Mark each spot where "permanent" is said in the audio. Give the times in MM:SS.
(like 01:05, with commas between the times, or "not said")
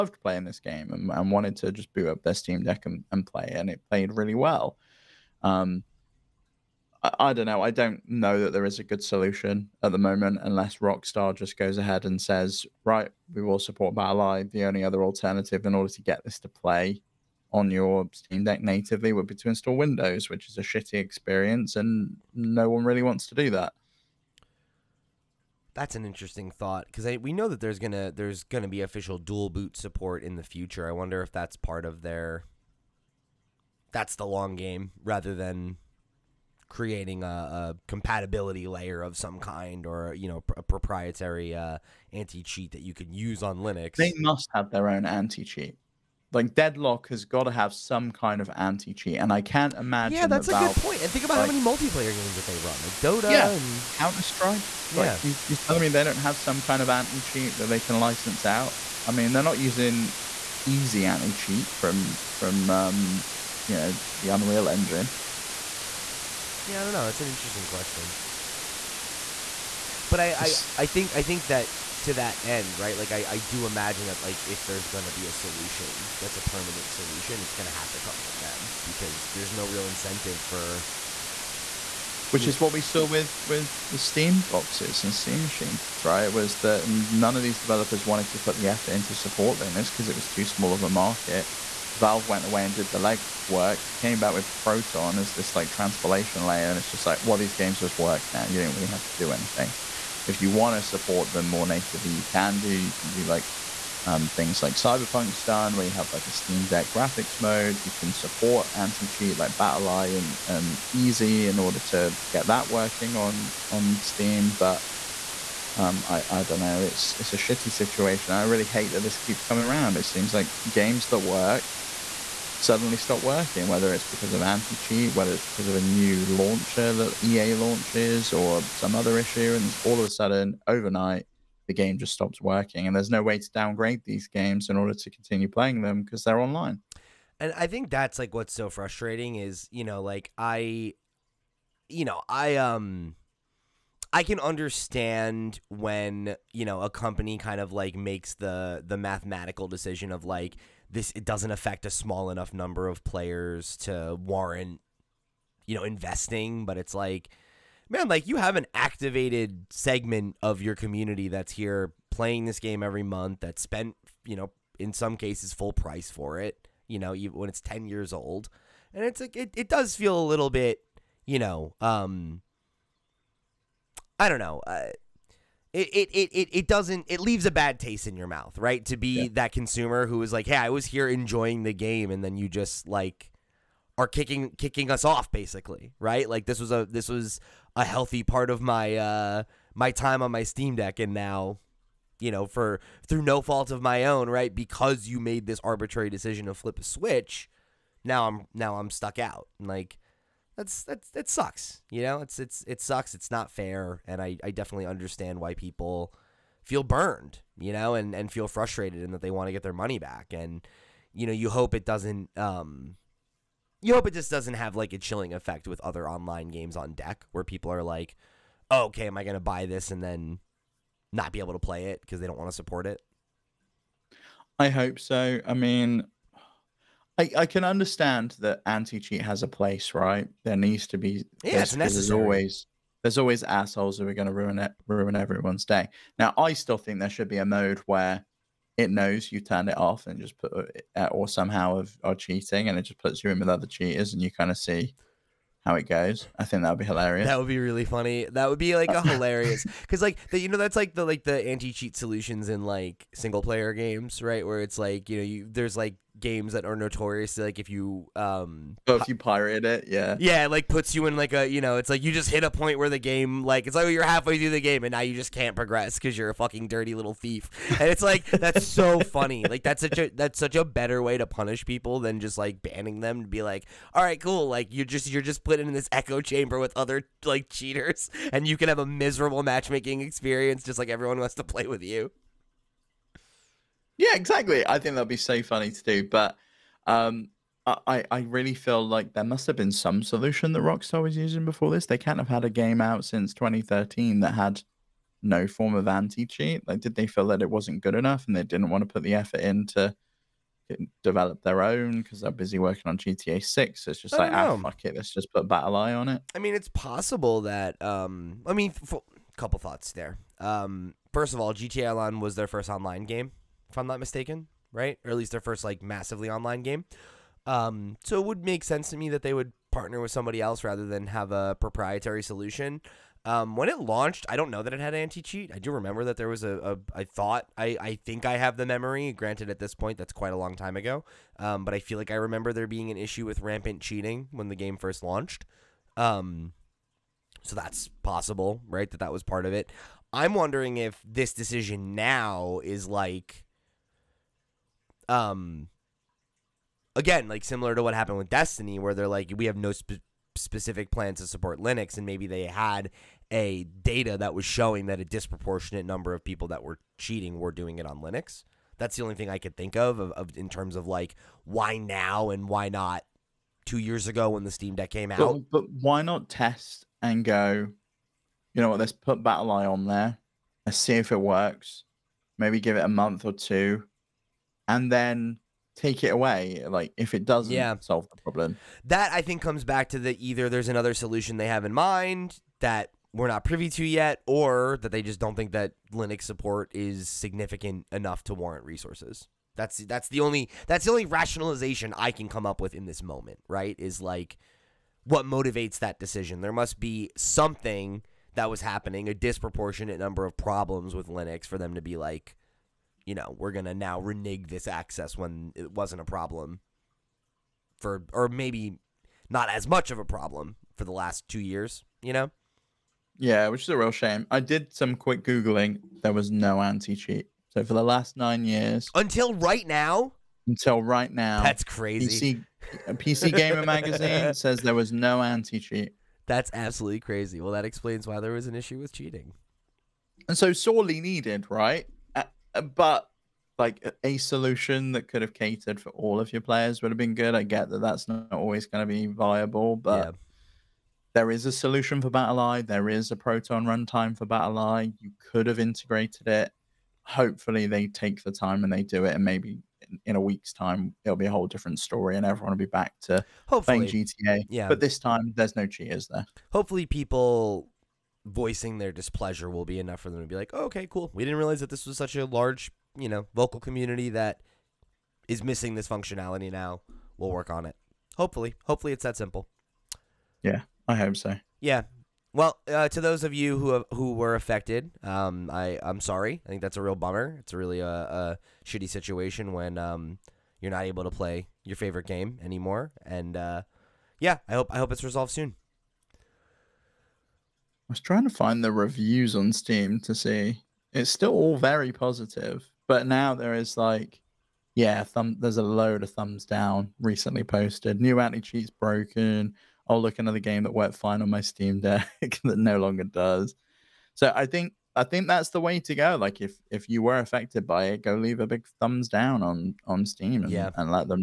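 01:16.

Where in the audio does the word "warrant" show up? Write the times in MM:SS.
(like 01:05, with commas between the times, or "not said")
02:34, 06:28.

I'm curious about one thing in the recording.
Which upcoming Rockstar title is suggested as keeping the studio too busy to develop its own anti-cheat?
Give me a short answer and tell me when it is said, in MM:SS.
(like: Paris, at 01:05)
GTA 6, at 05:02.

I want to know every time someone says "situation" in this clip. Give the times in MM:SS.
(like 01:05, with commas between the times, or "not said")
01:57, 07:58.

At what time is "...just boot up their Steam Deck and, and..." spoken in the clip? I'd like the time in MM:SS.
00:01.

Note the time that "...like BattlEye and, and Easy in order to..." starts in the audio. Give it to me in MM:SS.
01:49.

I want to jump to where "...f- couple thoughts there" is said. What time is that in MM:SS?
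05:08.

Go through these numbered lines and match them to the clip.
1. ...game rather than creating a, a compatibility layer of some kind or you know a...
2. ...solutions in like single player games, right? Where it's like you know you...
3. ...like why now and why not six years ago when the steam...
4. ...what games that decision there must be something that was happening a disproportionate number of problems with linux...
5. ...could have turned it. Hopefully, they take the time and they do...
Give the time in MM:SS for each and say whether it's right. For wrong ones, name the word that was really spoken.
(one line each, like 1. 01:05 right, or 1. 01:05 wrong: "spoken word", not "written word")
1. 00:34 right
2. 04:11 right
3. 06:00 wrong: "two", not "six"
4. 06:35 wrong: "motivates", not "games"
5. 07:25 wrong: "integrated", not "turned".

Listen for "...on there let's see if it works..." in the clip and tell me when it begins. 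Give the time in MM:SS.
06:09.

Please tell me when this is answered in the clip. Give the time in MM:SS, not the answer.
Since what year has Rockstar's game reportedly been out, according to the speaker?
04:53.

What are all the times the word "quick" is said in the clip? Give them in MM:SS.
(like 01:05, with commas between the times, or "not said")
06:54.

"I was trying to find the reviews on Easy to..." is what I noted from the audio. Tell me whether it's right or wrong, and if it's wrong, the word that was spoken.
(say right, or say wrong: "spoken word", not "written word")
wrong: "Steam", not "Easy".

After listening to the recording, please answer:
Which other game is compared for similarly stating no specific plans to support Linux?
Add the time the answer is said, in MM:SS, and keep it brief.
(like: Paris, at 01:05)
Destiny, at 05:48.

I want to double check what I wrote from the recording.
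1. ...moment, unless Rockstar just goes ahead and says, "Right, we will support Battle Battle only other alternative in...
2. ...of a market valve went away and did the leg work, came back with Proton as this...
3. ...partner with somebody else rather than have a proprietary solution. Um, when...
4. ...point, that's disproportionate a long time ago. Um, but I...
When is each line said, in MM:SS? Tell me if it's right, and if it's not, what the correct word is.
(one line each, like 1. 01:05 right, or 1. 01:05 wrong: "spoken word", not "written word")
1. 00:09 wrong: "The", not "Battle"
2. 01:30 right
3. 05:19 right
4. 05:29 wrong: "quite", not "disproportionate".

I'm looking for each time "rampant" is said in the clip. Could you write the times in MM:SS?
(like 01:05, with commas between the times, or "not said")
05:33.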